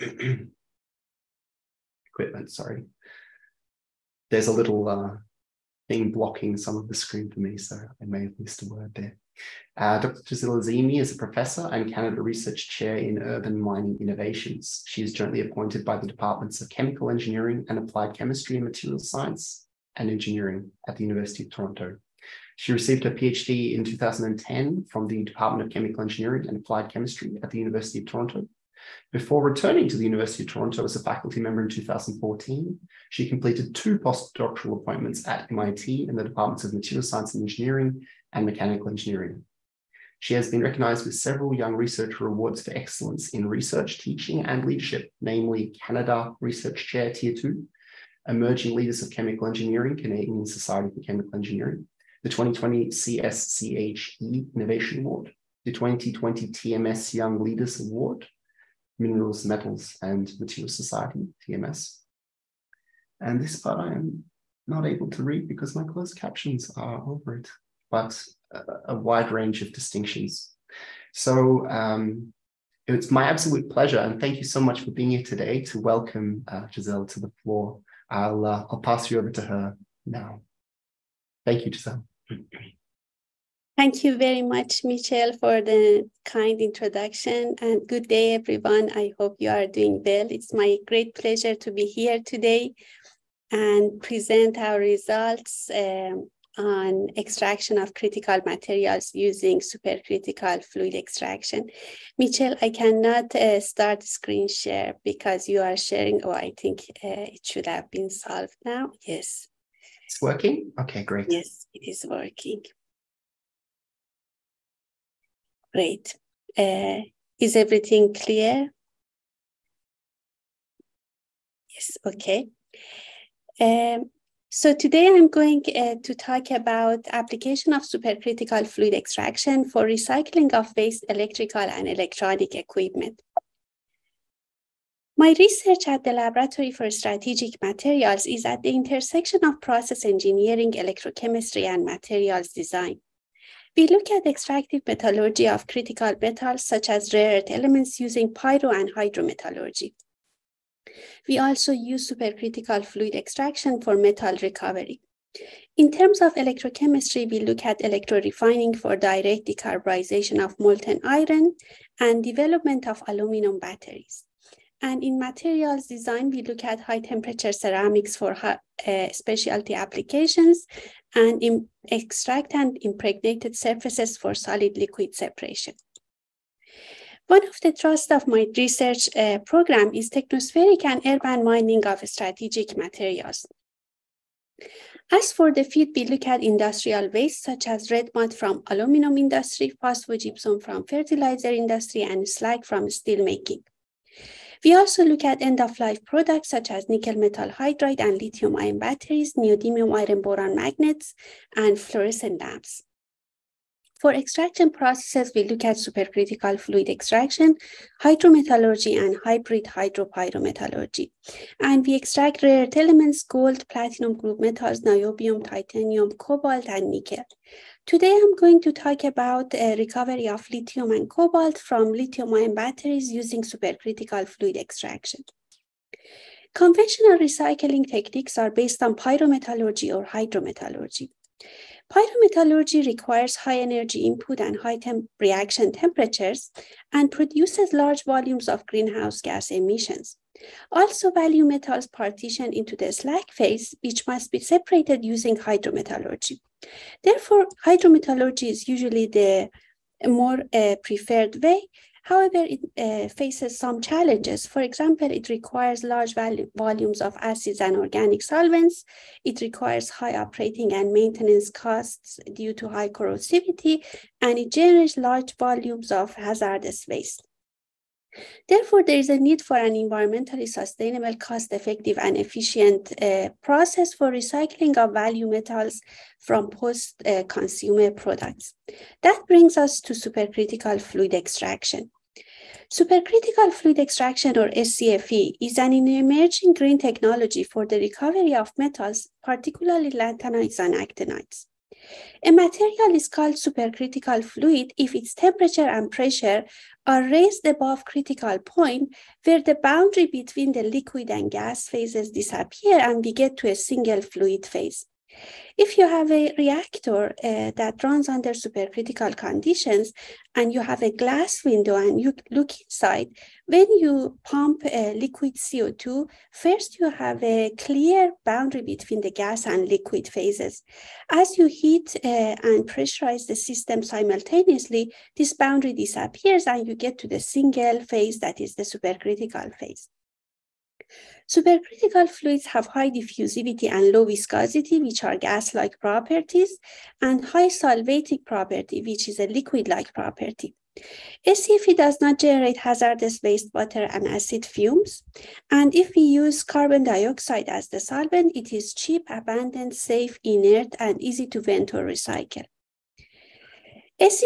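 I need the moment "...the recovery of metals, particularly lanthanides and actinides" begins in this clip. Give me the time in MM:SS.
04:47.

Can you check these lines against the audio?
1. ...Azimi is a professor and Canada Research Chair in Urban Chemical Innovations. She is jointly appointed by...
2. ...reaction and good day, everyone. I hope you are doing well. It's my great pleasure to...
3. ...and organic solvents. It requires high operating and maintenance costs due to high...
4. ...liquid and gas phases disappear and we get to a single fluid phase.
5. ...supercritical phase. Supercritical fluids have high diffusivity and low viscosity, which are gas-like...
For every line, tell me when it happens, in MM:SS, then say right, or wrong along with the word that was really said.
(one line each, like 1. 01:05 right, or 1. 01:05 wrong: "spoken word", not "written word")
1. 00:10 wrong: "Mining", not "Chemical"
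2. 01:26 wrong: "introduction", not "reaction"
3. 04:17 right
4. 05:00 right
5. 05:28 right.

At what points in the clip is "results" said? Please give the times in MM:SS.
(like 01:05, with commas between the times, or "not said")
01:34.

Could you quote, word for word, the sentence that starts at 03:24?
For extraction processes, we look at supercritical fluid extraction, hydrometallurgy, and hybrid hydropyrometallurgy.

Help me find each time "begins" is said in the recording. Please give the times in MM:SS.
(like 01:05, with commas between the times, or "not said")
not said.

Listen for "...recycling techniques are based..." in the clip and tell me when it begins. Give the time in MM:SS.
03:47.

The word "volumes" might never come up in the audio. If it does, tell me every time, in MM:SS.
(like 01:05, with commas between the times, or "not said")
03:58, 04:16, 04:25.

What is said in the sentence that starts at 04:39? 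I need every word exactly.
That brings us to supercritical fluid extraction.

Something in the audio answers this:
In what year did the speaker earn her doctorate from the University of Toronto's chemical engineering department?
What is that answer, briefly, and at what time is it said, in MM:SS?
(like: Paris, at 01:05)
2010, at 00:23.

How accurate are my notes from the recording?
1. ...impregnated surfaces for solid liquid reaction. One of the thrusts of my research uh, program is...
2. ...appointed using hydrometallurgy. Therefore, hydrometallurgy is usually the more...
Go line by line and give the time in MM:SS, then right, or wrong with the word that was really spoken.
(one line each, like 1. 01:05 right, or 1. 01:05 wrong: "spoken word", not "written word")
1. 02:52 wrong: "separation", not "reaction"
2. 04:04 wrong: "separated", not "appointed".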